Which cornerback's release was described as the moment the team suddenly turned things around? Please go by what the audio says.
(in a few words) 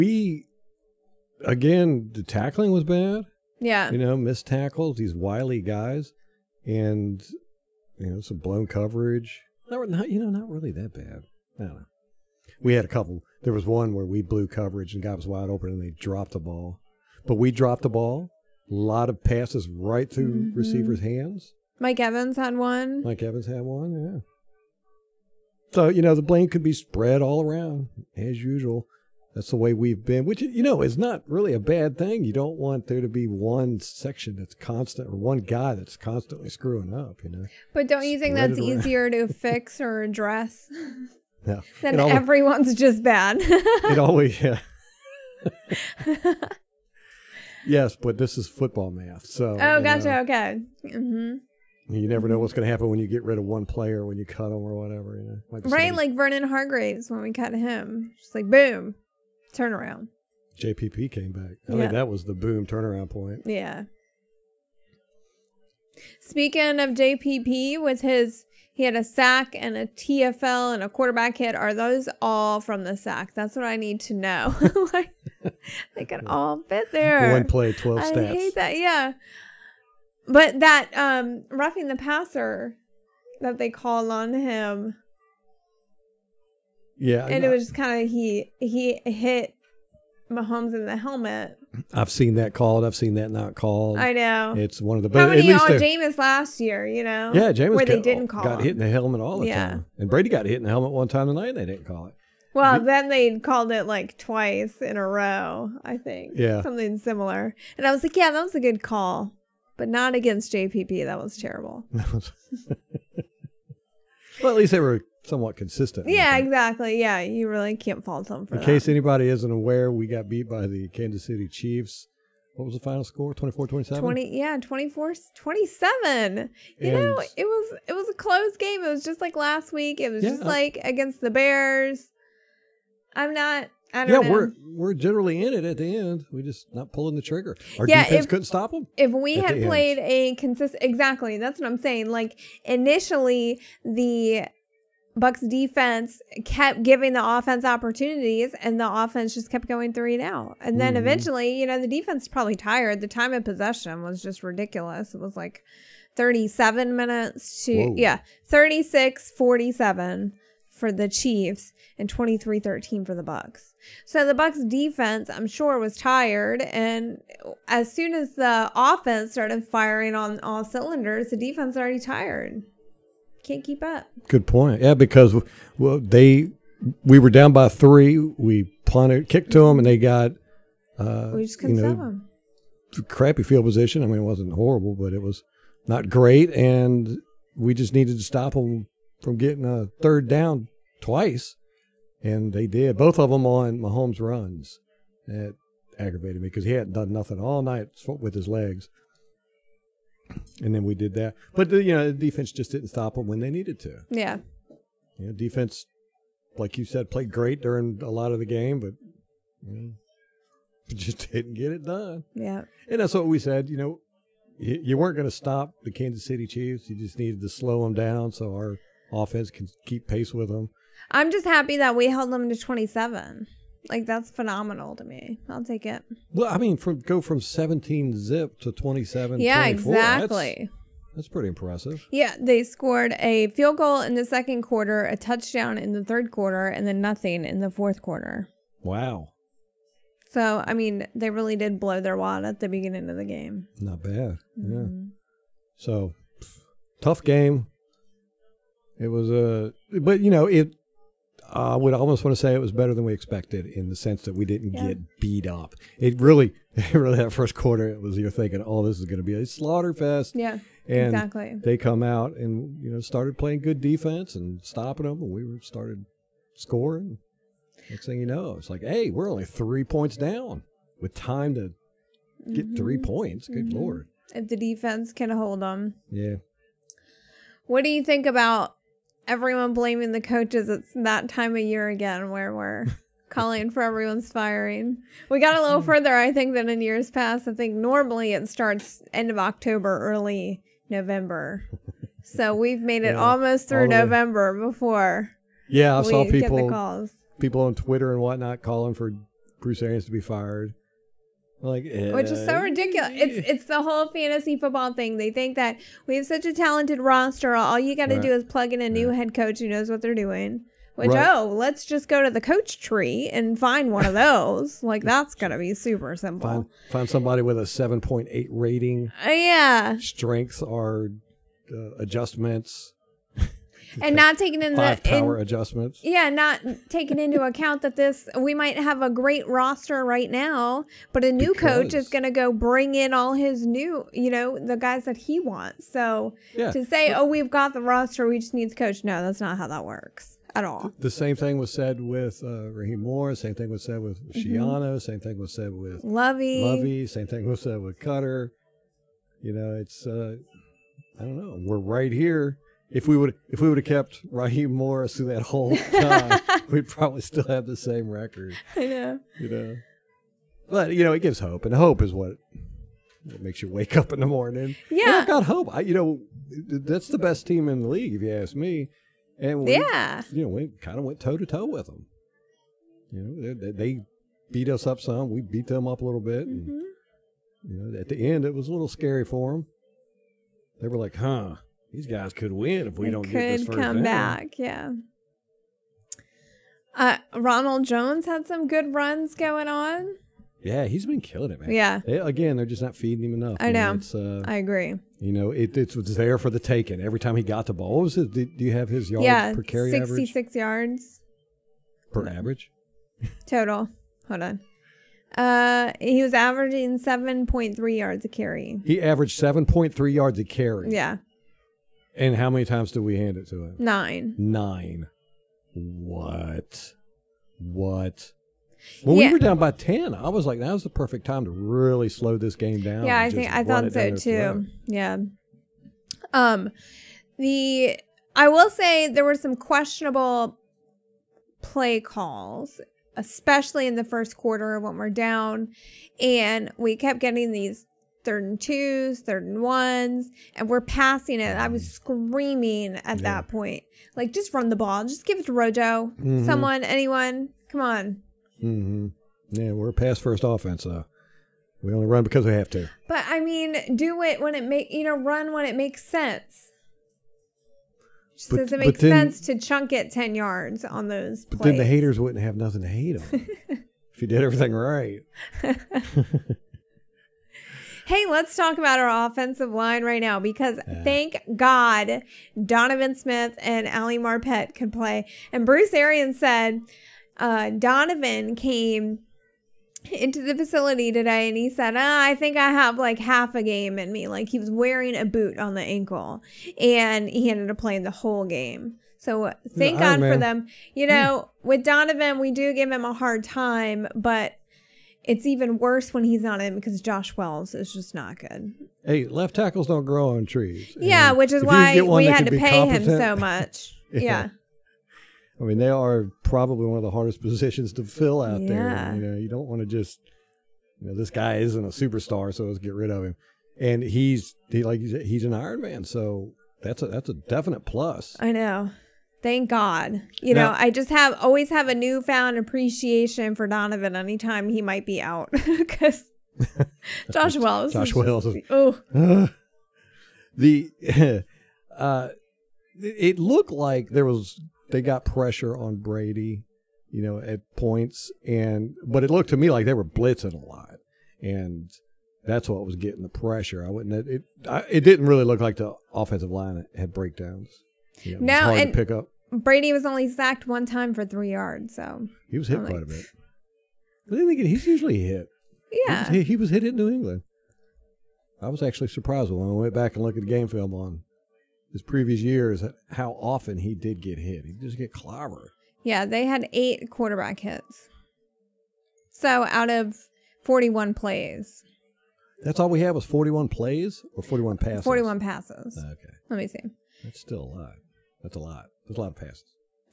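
Vernon Hargreaves.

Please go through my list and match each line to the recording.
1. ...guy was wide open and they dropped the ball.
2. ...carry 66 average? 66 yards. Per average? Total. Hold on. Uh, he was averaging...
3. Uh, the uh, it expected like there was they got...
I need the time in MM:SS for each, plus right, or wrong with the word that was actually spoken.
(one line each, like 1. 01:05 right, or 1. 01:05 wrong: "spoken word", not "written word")
1. 00:15 right
2. 06:39 right
3. 08:49 wrong: "looked", not "expected".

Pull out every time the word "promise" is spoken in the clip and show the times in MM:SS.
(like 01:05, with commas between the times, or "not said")
not said.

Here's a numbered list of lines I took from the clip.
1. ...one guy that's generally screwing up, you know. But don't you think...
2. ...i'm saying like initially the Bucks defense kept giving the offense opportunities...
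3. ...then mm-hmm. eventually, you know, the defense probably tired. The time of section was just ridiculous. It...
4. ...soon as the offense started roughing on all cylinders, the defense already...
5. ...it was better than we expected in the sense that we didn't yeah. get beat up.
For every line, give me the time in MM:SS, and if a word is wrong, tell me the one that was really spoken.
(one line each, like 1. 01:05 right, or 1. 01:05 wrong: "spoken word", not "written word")
1. 00:35 wrong: "constantly", not "generally"
2. 02:21 right
3. 02:30 wrong: "possession", not "section"
4. 02:47 wrong: "firing", not "roughing"
5. 04:12 right.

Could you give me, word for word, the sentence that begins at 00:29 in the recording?
That's the way we've been, which, you know, is not really a bad thing.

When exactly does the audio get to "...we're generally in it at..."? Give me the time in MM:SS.
02:14.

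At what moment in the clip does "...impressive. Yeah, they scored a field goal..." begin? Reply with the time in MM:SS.
03:51.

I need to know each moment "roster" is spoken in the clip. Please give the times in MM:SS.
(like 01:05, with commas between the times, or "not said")
05:06, 05:29, 05:37.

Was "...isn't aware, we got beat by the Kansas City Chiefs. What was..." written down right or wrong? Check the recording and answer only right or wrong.
right.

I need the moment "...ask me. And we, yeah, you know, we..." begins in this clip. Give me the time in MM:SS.
06:08.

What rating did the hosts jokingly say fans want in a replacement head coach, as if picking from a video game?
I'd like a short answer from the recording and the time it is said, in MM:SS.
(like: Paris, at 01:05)
7.8, at 05:17.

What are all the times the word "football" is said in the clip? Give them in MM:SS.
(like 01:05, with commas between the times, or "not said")
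00:48, 05:04.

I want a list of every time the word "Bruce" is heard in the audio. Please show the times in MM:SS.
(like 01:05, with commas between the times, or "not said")
04:59, 07:55.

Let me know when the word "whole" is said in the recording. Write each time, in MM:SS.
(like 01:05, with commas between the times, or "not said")
05:03, 05:55, 08:08.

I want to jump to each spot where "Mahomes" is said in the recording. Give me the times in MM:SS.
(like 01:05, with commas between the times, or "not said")
01:30, 03:13.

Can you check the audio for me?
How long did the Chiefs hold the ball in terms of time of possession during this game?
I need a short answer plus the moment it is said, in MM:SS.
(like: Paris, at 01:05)
36:47, at 02:38.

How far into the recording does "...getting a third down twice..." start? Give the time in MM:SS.
03:09.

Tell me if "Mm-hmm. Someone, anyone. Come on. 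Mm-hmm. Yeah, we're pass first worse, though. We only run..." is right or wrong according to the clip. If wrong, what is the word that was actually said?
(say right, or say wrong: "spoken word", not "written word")
wrong: "offense", not "worse".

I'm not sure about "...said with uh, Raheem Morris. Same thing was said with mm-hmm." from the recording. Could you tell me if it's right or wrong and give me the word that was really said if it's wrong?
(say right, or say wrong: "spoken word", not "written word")
right.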